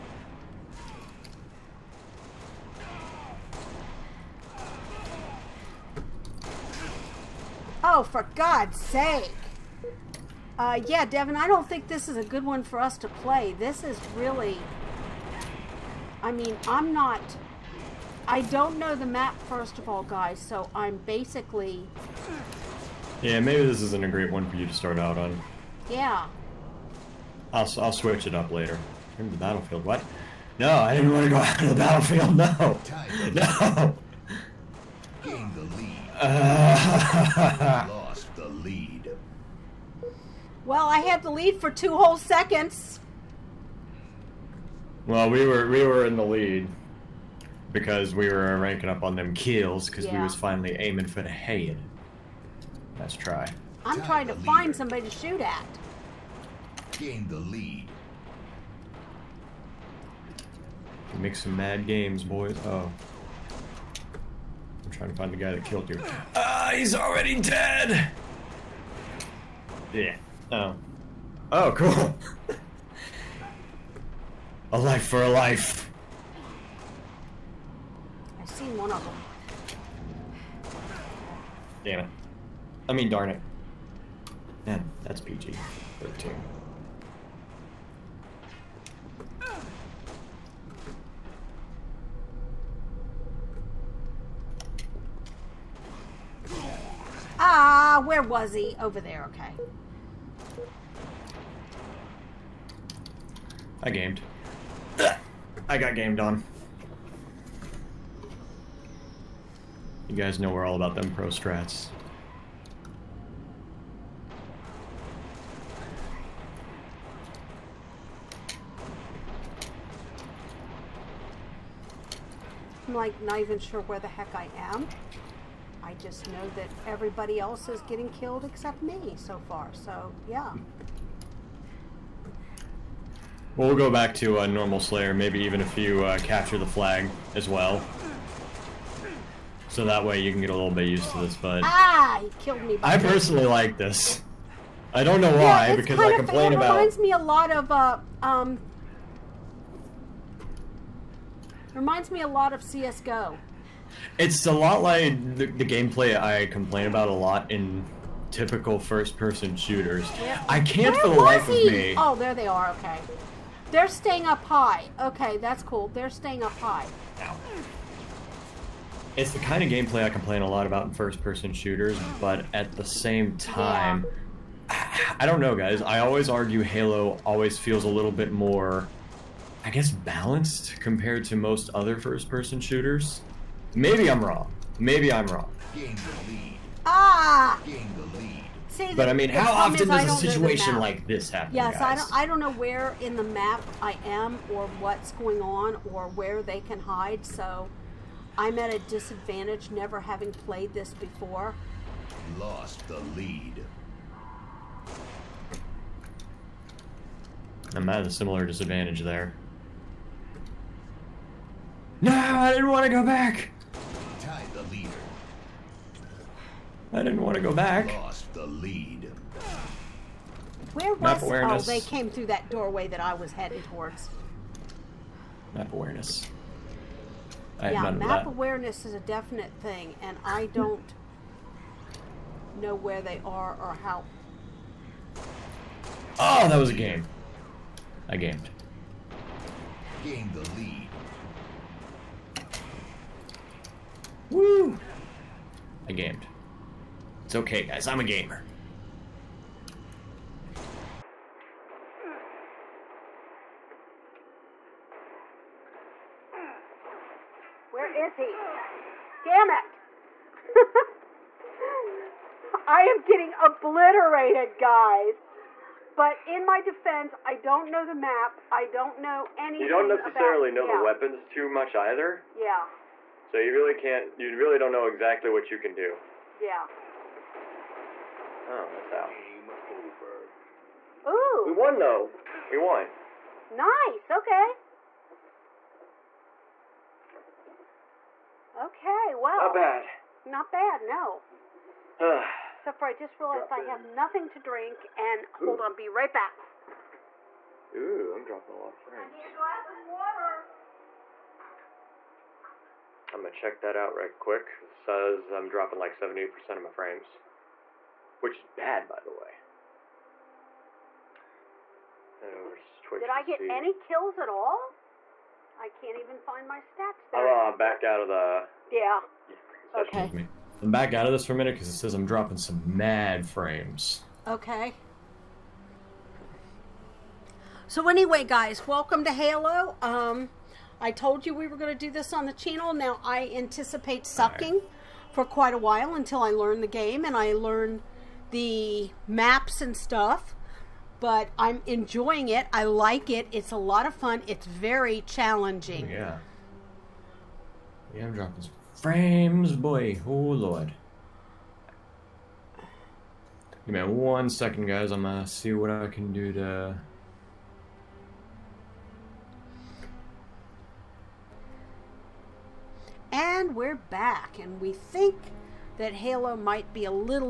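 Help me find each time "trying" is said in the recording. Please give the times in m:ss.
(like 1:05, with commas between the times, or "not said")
0:54, 1:04.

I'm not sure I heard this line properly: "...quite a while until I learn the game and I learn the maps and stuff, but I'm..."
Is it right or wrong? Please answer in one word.
right.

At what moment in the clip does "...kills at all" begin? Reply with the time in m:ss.
5:13.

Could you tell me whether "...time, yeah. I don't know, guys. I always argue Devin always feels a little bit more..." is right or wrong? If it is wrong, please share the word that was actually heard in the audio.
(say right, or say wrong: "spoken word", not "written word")
wrong: "Halo", not "Devin".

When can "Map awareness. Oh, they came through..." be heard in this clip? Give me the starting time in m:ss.
3:41.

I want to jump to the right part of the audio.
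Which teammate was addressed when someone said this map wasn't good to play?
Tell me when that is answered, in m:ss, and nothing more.
0:11.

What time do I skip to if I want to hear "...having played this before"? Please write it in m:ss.
3:20.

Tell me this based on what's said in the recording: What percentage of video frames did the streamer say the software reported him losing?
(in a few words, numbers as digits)
78%.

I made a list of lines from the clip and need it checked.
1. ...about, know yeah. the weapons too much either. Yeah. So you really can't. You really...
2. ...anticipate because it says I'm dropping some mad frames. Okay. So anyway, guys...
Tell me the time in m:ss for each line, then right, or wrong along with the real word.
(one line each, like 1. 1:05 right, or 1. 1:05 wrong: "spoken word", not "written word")
1. 4:30 right
2. 5:21 wrong: "minute", not "anticipate".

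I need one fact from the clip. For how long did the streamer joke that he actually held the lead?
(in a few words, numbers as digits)
2 seconds.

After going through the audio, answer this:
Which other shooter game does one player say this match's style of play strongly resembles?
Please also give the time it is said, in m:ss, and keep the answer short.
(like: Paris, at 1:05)
CSGO, at 2:32.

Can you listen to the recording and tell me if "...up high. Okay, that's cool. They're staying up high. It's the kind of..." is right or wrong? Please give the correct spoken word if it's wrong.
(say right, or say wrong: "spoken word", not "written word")
right.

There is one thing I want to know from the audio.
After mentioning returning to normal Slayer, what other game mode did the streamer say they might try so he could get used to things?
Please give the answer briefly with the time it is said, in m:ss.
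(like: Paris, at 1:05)
capture the flag, at 2:16.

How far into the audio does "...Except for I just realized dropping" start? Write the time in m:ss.
4:52.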